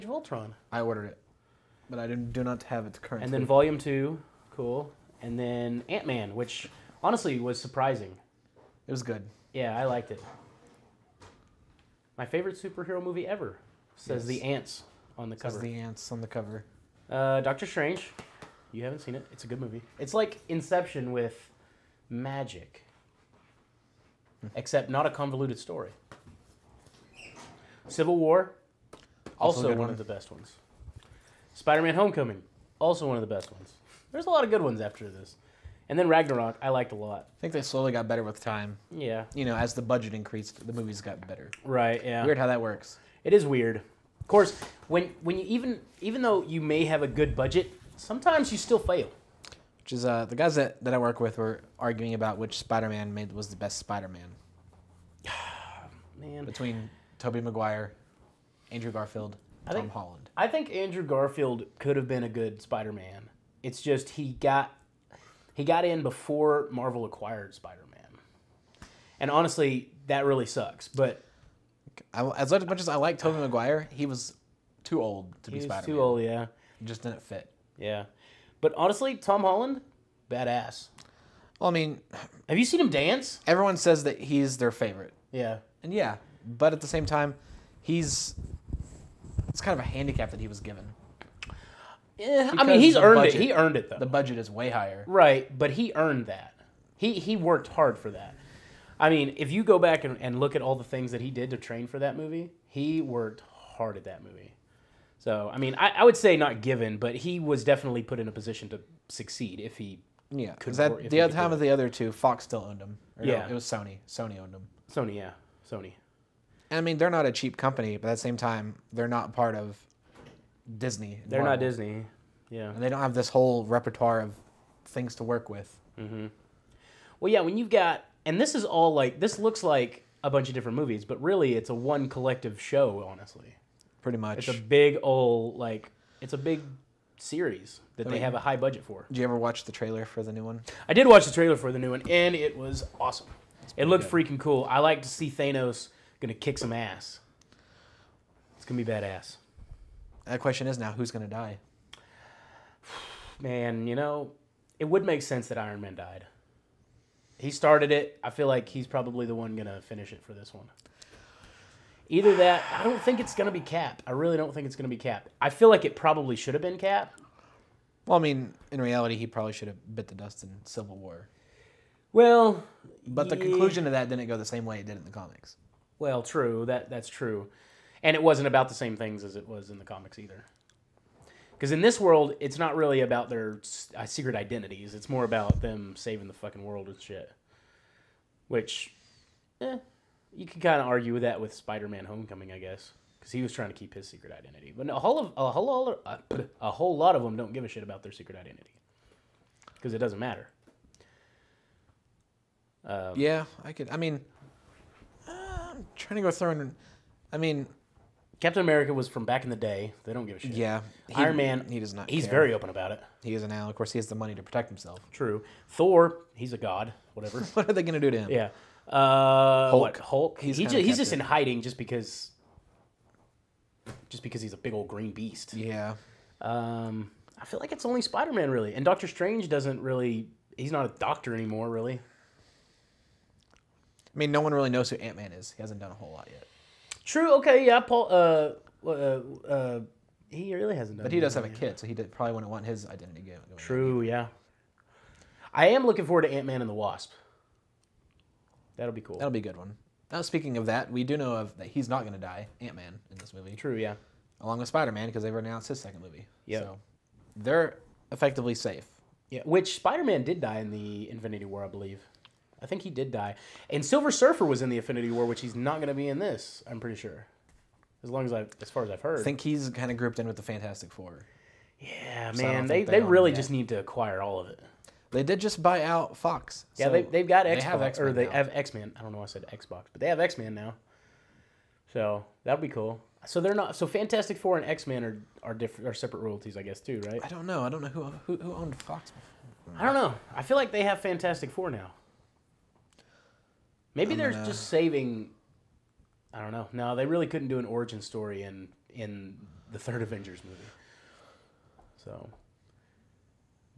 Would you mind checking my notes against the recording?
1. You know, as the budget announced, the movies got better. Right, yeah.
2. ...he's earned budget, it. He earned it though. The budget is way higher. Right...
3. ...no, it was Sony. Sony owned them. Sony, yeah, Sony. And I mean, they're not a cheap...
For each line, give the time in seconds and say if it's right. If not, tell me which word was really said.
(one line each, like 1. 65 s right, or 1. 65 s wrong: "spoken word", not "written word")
1. 39 s wrong: "increased", not "announced"
2. 92 s right
3. 113 s right.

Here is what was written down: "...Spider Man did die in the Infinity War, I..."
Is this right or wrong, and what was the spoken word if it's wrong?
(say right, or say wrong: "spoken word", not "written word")
right.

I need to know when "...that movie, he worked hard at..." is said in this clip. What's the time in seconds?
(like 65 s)
101 s.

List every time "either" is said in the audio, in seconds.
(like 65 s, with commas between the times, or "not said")
162 s, 180 s.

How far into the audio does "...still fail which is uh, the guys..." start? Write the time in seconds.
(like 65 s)
48 s.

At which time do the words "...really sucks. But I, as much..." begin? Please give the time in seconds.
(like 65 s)
70 s.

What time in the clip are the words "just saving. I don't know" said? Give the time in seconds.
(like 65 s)
294 s.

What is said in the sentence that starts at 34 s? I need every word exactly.
There's a lot of good ones after this.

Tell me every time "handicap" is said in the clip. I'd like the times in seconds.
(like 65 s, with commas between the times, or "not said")
89 s.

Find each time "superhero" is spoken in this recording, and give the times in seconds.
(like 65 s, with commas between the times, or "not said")
12 s.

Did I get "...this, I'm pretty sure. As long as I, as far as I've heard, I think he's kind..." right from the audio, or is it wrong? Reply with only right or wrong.
right.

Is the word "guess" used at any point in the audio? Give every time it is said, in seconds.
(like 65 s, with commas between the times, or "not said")
192 s, 286 s.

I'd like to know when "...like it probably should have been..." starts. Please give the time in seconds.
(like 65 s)
165 s.